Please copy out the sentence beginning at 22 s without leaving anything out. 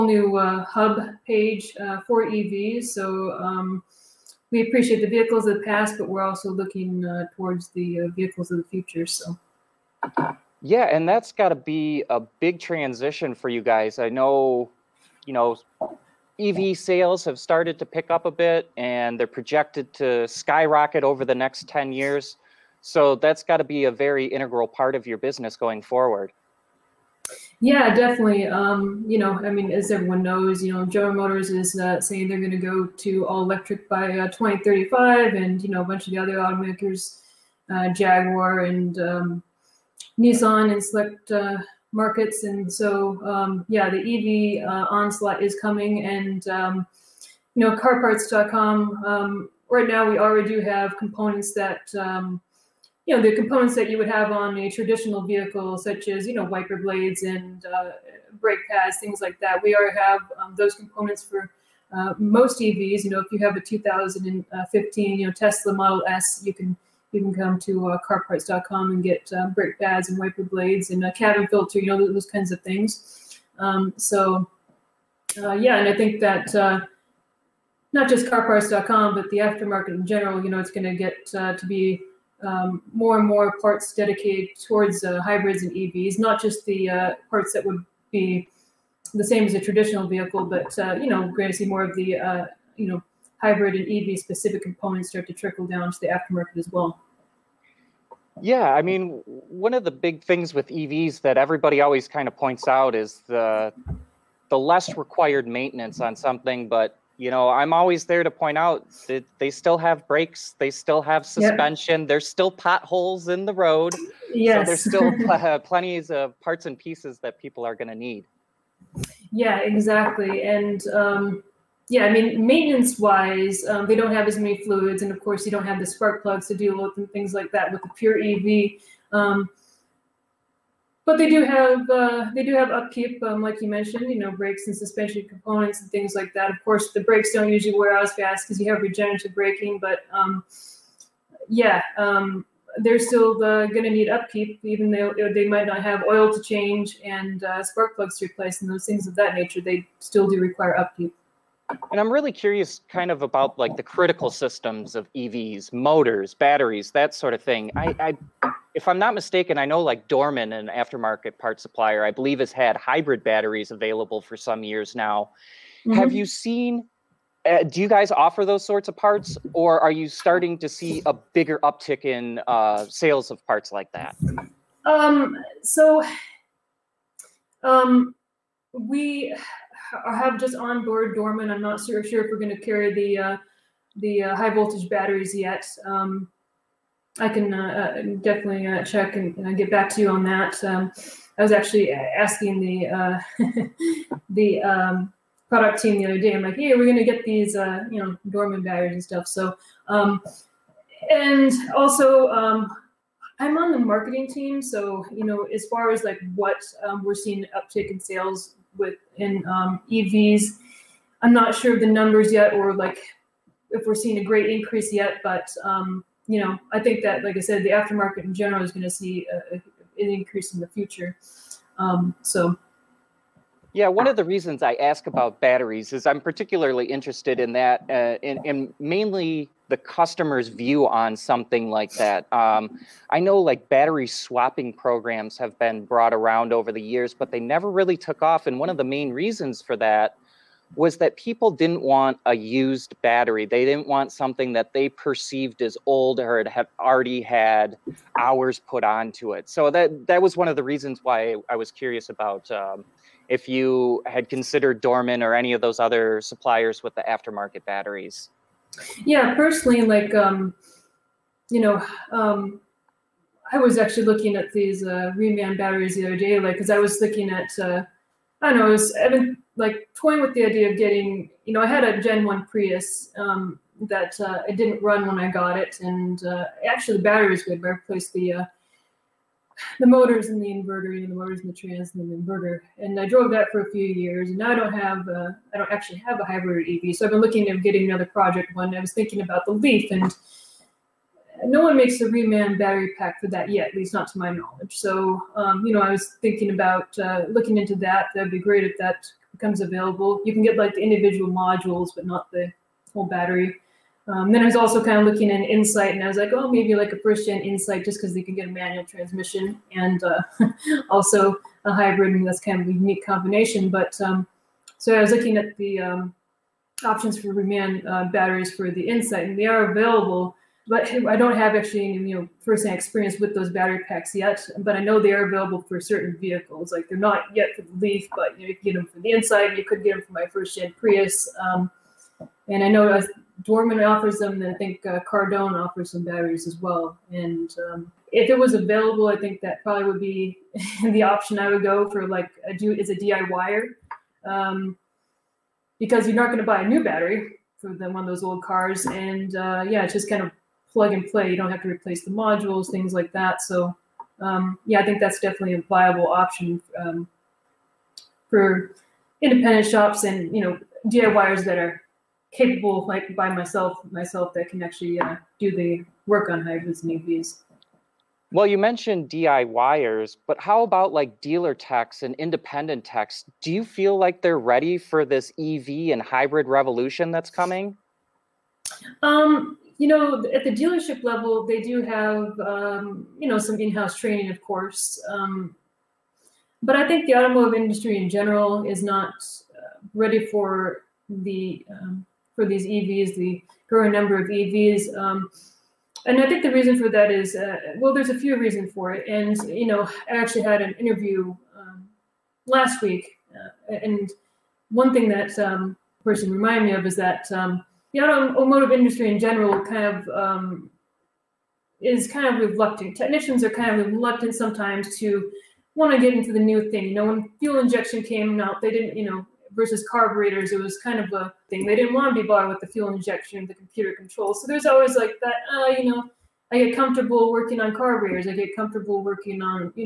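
So that's got to be a very integral part of your business going forward.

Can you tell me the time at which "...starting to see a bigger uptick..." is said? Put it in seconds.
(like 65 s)
170 s.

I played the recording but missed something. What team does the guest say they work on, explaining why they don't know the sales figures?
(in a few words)
marketing team.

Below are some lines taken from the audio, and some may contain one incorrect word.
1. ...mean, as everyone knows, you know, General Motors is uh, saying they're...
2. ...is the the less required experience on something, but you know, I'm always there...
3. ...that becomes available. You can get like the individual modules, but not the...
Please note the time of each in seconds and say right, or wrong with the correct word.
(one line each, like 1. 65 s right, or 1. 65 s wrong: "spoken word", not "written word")
1. 29 s right
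2. 102 s wrong: "maintenance", not "experience"
3. 298 s right.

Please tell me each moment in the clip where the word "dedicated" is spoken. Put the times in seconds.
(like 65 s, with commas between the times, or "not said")
83 s.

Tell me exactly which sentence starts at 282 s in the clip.
And I drove that for a few years.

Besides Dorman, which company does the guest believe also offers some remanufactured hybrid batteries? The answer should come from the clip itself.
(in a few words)
Cardone.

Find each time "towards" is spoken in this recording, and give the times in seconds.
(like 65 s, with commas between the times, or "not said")
7 s, 84 s.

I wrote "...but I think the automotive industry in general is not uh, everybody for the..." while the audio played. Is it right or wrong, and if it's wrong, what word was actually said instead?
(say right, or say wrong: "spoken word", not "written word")
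wrong: "ready", not "everybody".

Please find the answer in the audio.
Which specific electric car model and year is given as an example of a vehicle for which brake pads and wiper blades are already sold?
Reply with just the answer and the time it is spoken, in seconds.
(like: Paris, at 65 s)
2015 Tesla Model S, at 63 s.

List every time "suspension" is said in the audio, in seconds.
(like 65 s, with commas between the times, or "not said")
111 s, 134 s.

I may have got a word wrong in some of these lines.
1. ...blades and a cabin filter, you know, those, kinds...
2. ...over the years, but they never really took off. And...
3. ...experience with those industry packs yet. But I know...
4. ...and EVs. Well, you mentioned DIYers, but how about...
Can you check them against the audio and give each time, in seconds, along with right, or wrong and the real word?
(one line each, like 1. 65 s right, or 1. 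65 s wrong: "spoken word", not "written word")
1. 70 s right
2. 236 s right
3. 322 s wrong: "battery", not "industry"
4. 366 s right.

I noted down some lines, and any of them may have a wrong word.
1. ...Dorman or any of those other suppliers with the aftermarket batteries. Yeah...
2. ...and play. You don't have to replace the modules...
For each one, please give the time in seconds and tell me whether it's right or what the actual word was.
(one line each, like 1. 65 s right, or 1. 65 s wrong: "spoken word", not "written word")
1. 254 s right
2. 350 s right.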